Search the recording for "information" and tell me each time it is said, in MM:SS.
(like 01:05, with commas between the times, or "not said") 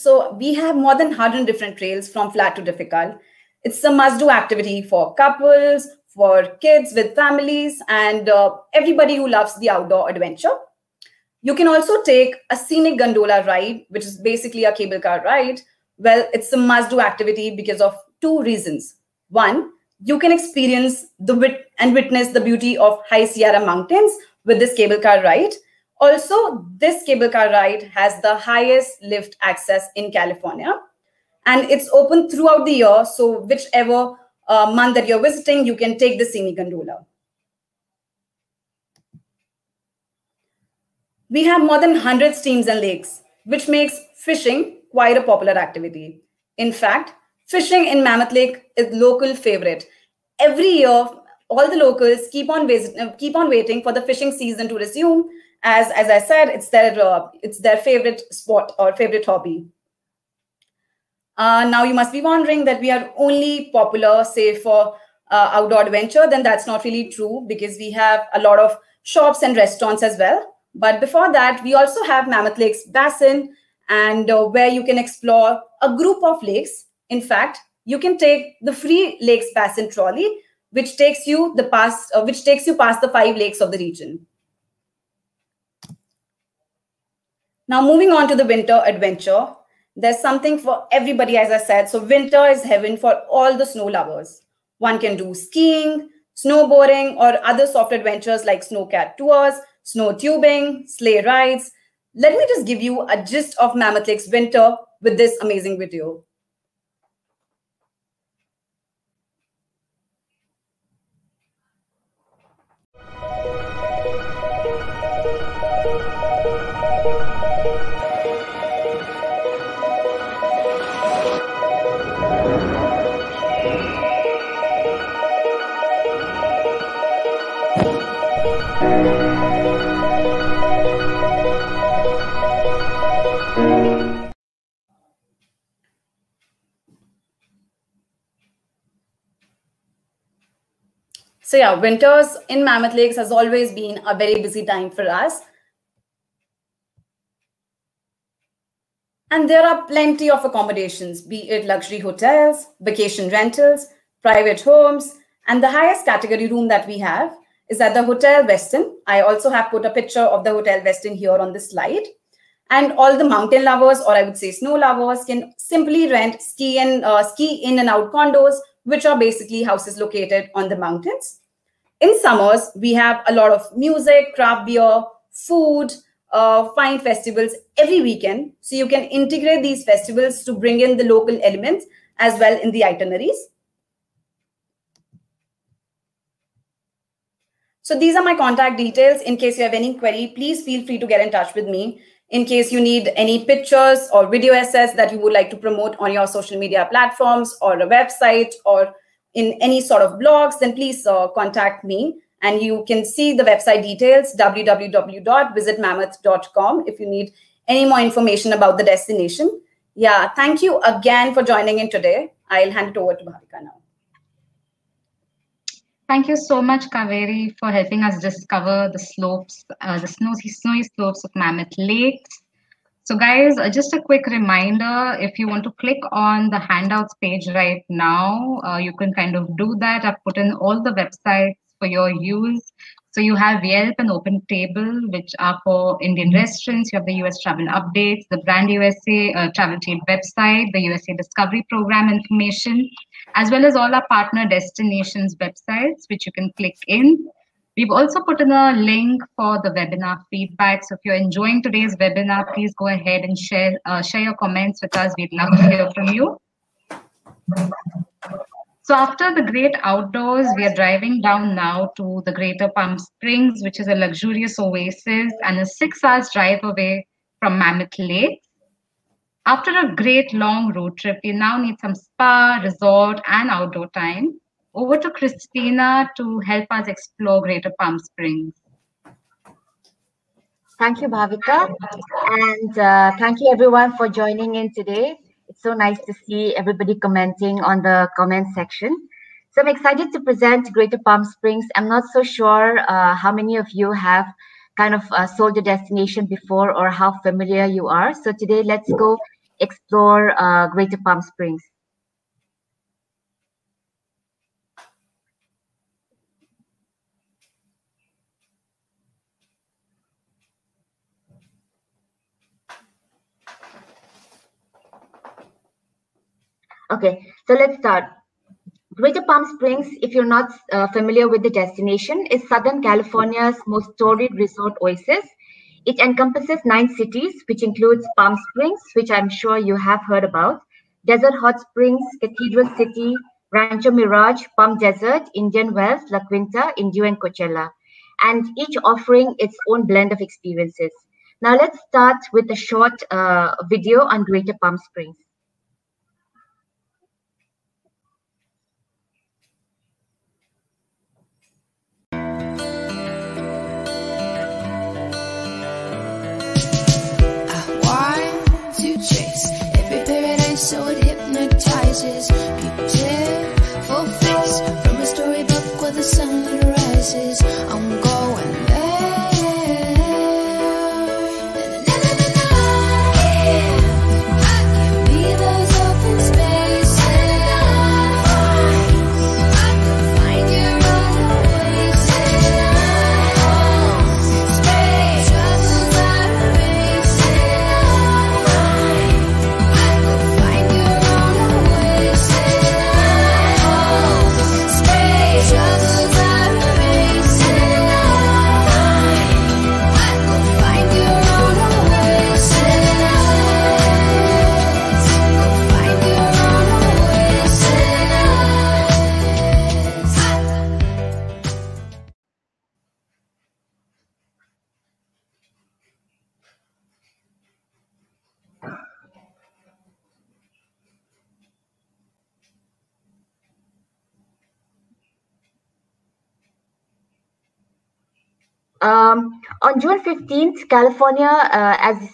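03:28, 04:02.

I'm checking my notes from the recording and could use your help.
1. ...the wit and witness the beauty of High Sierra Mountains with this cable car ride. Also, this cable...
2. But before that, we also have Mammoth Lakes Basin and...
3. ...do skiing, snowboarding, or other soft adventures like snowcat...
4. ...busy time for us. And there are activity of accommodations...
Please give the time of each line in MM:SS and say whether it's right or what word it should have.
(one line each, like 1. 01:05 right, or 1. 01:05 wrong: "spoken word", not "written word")
1. 00:21 right
2. 01:10 right
3. 01:35 right
4. 02:24 wrong: "plenty", not "activity".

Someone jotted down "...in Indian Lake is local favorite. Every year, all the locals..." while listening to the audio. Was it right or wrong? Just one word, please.
wrong.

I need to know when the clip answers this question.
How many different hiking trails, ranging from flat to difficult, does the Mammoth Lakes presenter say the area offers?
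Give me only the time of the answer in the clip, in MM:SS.
00:00.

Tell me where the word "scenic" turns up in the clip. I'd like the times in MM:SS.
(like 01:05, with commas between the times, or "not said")
00:12, 00:36.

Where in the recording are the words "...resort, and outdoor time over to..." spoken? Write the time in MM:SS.
04:32.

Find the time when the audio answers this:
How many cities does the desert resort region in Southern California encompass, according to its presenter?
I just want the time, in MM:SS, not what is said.
05:26.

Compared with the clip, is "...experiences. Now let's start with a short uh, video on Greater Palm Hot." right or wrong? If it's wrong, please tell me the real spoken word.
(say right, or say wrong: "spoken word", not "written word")
wrong: "Springs", not "Hot".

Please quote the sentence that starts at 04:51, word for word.
I'm not so sure uh, how many of you have kind of uh, sold the destination before or how familiar you are.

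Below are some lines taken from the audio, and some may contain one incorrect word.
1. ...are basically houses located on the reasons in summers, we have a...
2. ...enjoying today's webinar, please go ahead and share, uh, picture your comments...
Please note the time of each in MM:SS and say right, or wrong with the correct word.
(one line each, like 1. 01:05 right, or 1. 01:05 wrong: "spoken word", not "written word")
1. 02:49 wrong: "mountains", not "reasons"
2. 04:11 wrong: "share", not "picture".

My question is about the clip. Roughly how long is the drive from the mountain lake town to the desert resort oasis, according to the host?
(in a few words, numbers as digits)
6 hours.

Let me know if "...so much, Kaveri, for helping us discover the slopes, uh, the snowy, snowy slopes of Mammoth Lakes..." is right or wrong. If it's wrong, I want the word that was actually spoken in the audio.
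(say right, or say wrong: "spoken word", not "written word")
right.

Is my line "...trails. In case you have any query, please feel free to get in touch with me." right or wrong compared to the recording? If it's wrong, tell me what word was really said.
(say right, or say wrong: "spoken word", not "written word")
wrong: "details", not "trails".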